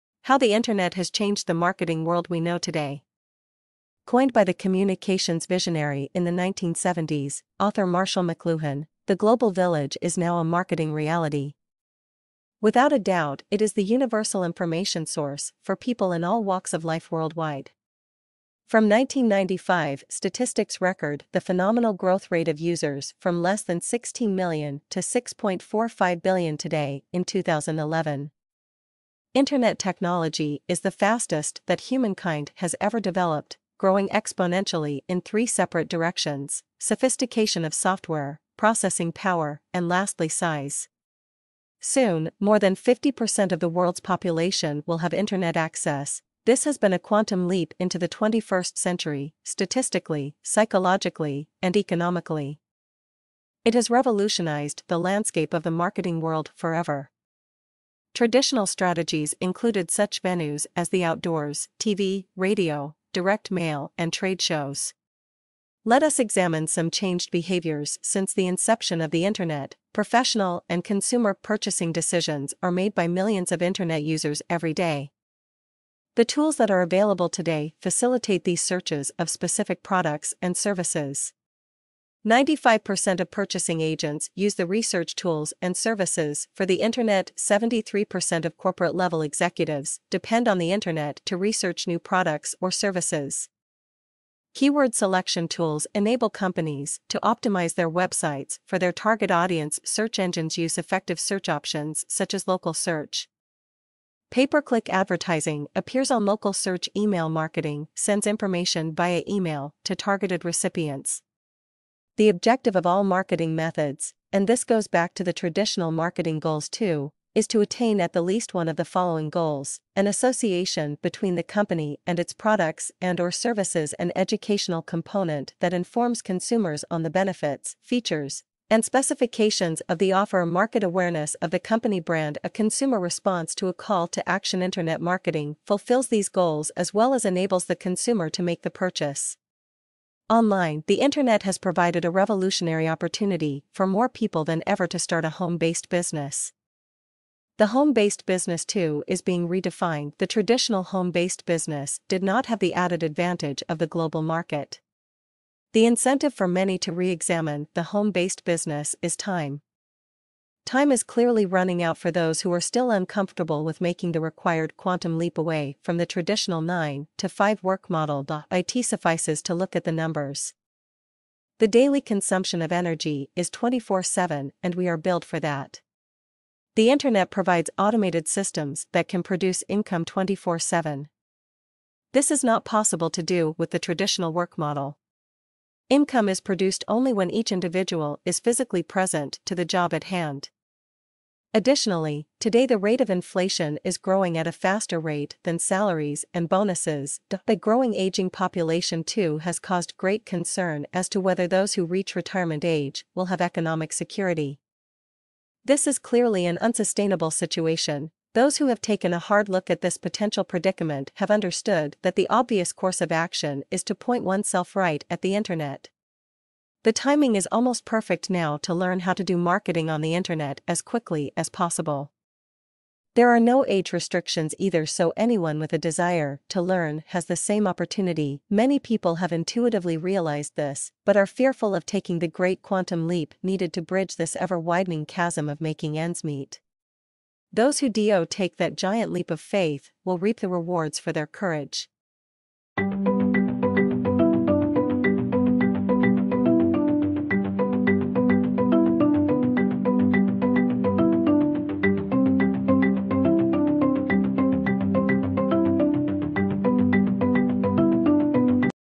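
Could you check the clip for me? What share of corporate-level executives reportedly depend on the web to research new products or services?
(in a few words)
73%.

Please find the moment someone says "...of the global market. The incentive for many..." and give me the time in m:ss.
2:33.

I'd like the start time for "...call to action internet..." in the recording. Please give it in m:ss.
2:13.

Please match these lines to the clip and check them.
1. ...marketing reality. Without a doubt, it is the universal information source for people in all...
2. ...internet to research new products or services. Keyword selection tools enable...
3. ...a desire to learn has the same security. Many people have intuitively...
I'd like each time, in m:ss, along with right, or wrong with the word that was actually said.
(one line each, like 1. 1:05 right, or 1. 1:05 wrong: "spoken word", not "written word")
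1. 0:10 right
2. 1:30 right
3. 3:45 wrong: "opportunity", not "security".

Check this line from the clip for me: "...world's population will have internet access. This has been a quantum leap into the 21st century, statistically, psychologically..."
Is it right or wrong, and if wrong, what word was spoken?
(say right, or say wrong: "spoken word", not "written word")
right.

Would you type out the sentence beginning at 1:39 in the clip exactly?
Search engines use effective search options such as local search.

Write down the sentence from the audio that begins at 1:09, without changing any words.
Professional and consumer purchasing decisions are made by millions of Internet users every day.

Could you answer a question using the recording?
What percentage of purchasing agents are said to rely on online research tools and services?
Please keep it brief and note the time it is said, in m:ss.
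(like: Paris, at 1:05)
95%, at 1:22.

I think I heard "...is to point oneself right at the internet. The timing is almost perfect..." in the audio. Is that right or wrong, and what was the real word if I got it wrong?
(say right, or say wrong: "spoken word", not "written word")
right.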